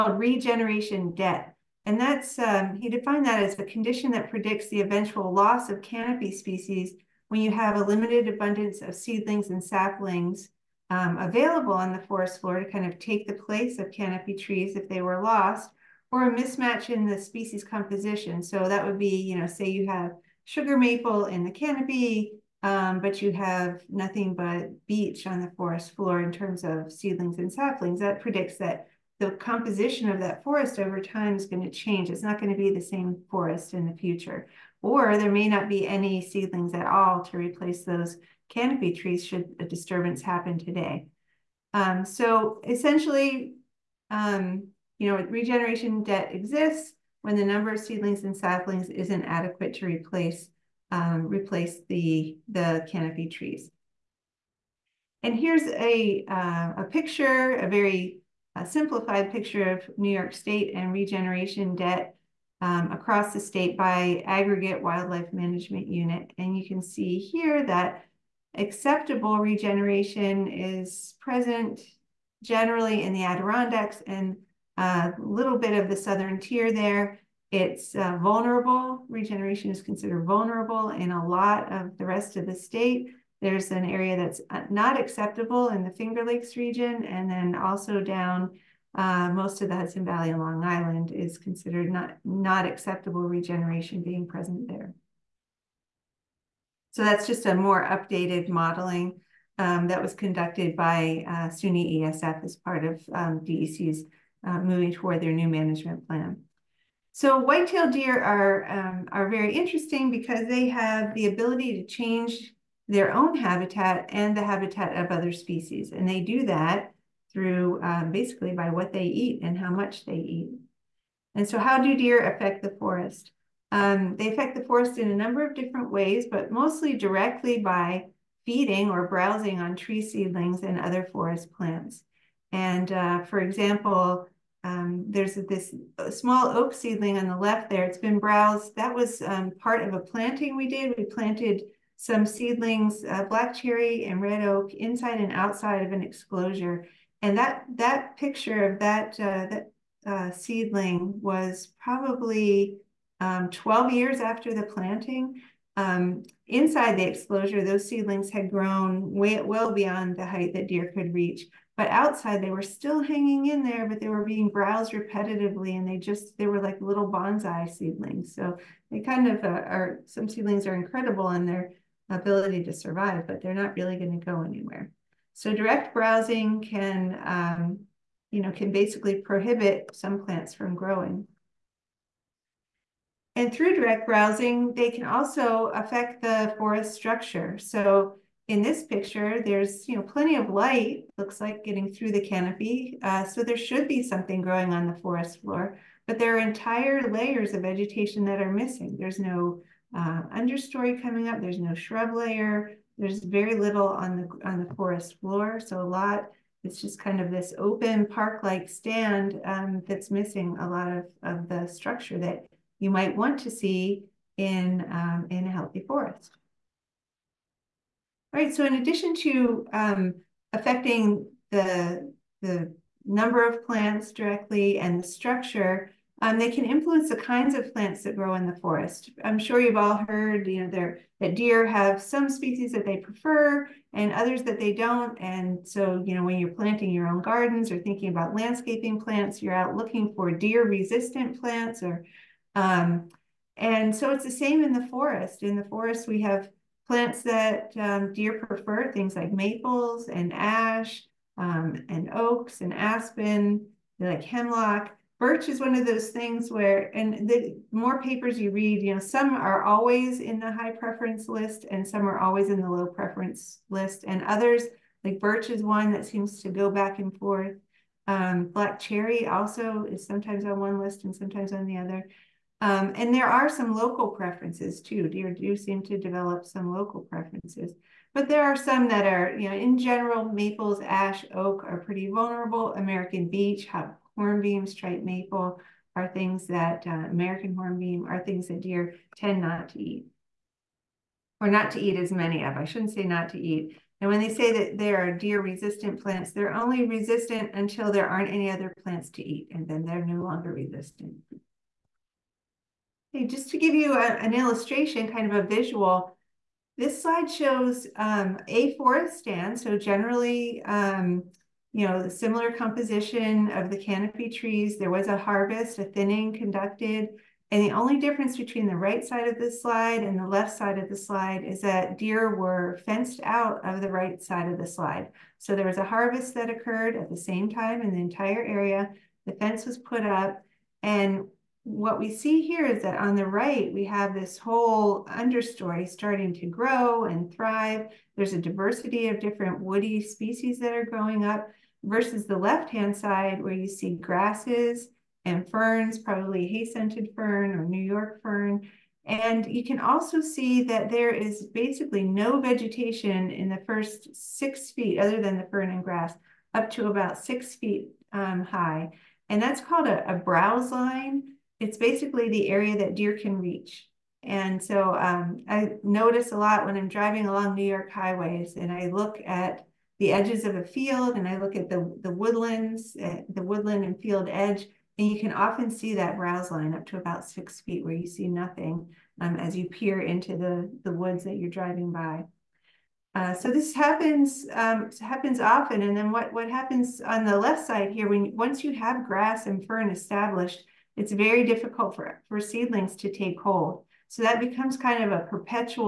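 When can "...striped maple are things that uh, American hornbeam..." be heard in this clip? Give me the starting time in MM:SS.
04:44.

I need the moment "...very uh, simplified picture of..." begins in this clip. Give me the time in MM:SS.
00:57.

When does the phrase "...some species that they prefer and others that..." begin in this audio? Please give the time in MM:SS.
03:52.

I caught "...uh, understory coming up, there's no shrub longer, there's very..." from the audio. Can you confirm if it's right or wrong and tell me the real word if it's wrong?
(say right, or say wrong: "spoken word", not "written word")
wrong: "layer", not "longer".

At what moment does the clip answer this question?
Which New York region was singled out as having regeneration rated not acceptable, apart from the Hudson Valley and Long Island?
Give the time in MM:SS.
01:25.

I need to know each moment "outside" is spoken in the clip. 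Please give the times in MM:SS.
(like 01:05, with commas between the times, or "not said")
02:25, 02:41.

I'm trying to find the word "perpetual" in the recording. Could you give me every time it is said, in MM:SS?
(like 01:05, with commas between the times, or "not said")
06:35.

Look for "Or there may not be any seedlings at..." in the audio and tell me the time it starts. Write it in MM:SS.
00:34.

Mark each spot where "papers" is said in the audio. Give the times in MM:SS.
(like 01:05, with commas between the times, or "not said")
04:18.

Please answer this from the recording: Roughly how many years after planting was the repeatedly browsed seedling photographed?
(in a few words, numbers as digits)
12 years.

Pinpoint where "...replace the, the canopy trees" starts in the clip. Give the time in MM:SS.
00:51.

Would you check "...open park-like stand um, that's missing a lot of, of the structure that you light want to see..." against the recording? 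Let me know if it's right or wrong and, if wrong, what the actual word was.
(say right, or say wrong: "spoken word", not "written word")
wrong: "might", not "light".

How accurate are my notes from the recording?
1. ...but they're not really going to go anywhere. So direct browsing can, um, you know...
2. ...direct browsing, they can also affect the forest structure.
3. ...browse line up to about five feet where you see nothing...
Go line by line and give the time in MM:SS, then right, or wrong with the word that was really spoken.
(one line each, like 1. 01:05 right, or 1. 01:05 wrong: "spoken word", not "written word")
1. 02:53 right
2. 03:03 right
3. 06:16 wrong: "six", not "five".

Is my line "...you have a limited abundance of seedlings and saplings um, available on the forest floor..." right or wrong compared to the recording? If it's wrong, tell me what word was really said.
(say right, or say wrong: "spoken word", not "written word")
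right.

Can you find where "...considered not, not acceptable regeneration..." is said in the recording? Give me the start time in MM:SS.
01:31.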